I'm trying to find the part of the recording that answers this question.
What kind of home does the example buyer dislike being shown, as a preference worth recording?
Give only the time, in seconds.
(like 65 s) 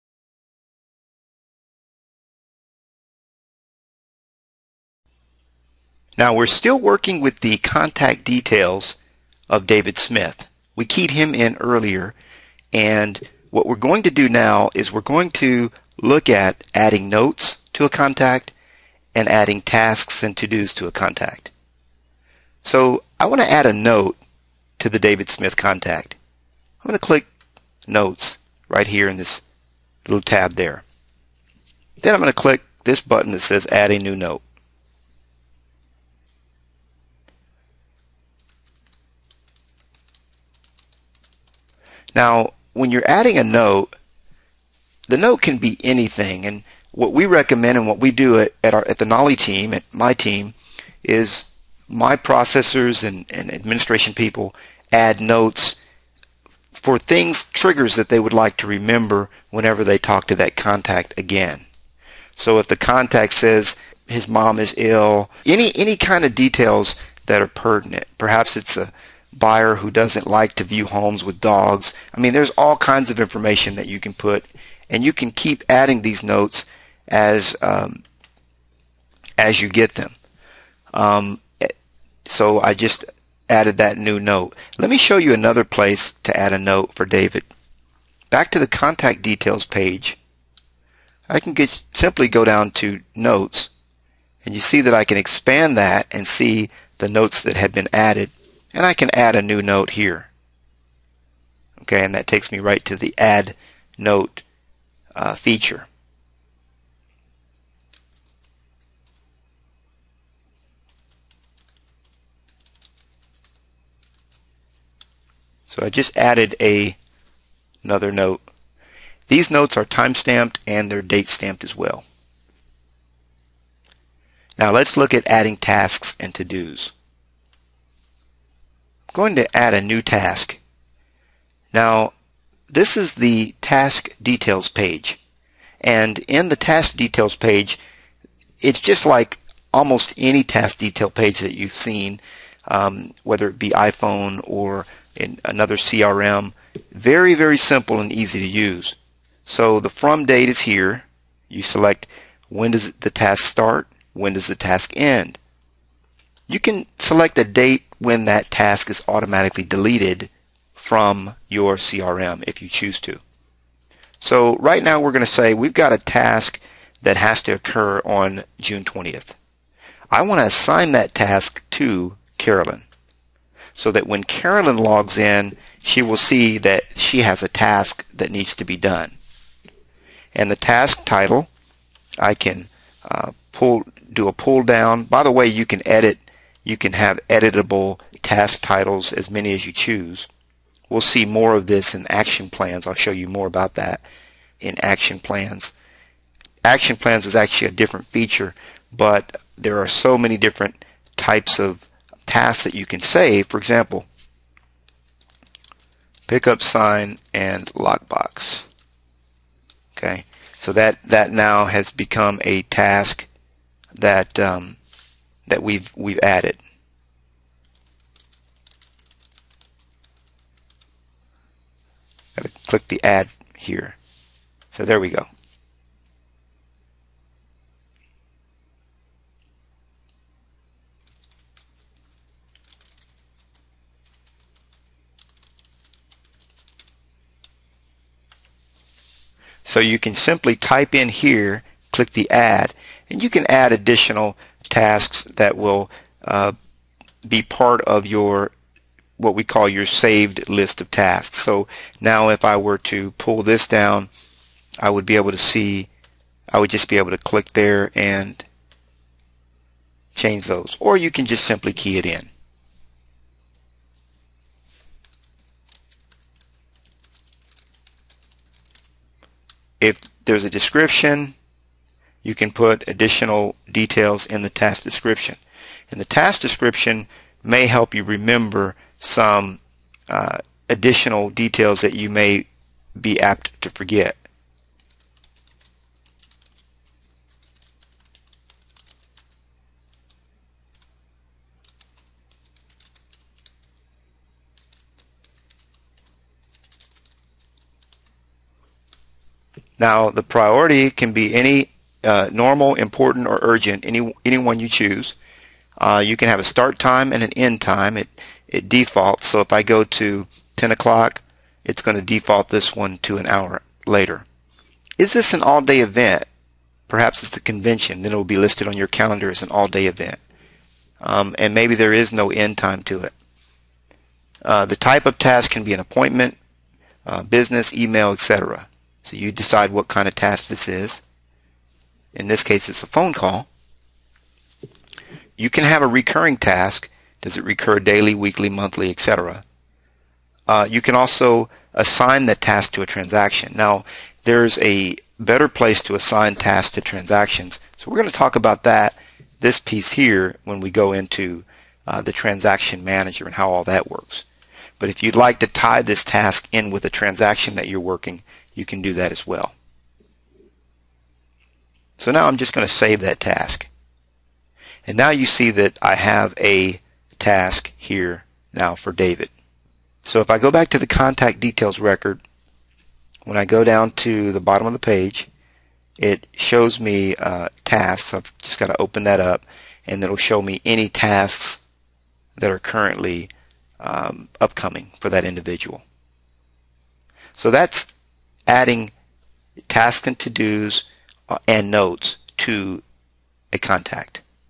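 70 s.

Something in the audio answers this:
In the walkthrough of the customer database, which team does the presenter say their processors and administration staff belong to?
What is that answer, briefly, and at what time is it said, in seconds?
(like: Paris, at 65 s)
the Nolly team, at 48 s.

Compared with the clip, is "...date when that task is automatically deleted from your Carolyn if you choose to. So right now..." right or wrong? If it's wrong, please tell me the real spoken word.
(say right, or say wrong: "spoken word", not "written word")
wrong: "CRM", not "Carolyn".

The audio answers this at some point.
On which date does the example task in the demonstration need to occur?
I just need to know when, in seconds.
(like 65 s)
168 s.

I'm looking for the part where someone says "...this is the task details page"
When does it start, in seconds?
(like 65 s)
132 s.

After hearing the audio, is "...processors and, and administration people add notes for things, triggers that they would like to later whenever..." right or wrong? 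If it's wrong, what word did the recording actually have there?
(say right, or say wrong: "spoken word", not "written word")
wrong: "remember", not "later".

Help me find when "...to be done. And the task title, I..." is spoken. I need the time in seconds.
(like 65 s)
178 s.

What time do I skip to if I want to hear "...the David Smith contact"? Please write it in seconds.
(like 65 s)
24 s.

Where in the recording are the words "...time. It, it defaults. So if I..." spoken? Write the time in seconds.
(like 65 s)
307 s.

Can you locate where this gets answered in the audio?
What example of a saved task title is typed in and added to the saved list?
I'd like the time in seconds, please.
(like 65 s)
206 s.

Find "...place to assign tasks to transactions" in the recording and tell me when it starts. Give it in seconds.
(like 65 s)
345 s.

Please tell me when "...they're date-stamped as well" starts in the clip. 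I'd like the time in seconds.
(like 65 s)
120 s.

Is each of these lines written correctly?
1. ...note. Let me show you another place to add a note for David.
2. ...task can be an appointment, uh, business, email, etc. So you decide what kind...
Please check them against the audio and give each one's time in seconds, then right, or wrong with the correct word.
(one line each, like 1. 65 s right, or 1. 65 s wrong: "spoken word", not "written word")
1. 84 s right
2. 325 s right.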